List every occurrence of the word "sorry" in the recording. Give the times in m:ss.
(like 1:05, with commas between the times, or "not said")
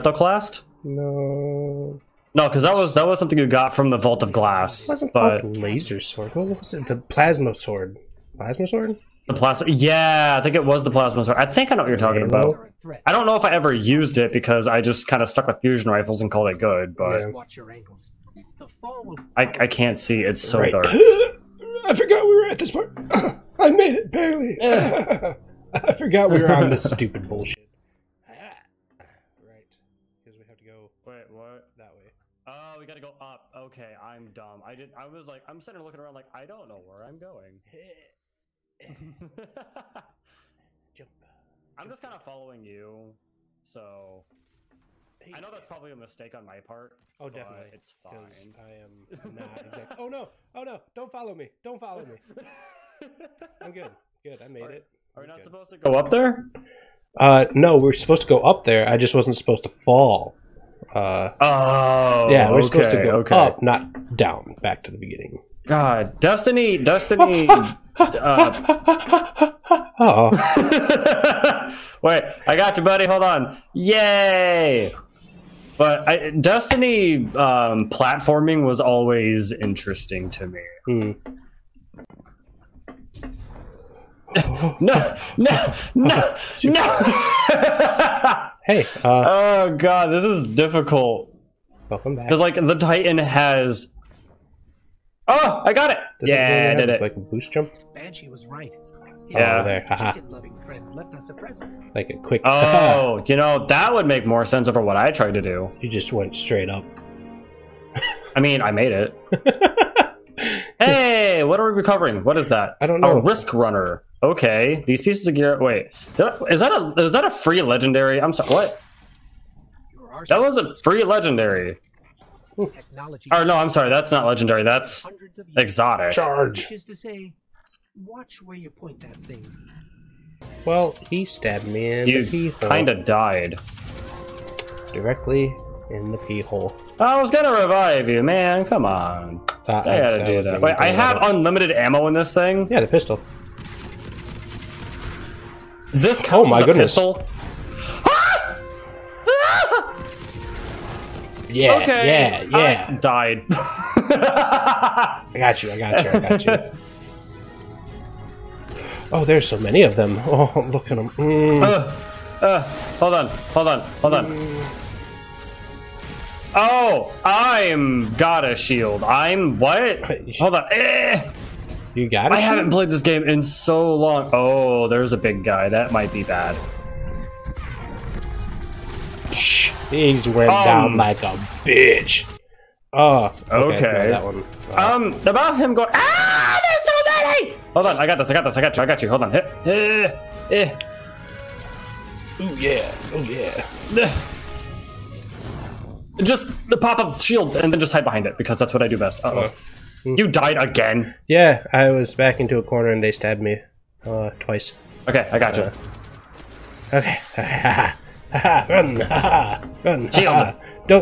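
1:58, 2:03.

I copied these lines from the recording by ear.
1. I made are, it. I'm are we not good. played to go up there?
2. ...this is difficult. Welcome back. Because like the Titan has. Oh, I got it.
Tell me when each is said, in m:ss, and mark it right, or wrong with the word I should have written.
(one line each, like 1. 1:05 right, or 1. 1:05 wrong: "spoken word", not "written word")
1. 0:54 wrong: "supposed", not "played"
2. 1:30 right.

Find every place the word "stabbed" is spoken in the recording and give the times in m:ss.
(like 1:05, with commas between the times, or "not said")
2:11, 3:23.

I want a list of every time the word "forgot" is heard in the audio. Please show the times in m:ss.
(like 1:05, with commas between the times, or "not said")
0:21, 0:25.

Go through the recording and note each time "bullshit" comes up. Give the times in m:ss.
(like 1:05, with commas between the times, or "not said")
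0:27.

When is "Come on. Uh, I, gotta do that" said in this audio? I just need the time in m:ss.
2:18.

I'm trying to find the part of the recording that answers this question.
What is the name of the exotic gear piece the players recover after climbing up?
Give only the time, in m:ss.
1:53.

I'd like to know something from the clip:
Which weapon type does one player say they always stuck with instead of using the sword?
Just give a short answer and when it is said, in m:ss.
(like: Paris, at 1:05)
fusion rifles, at 0:15.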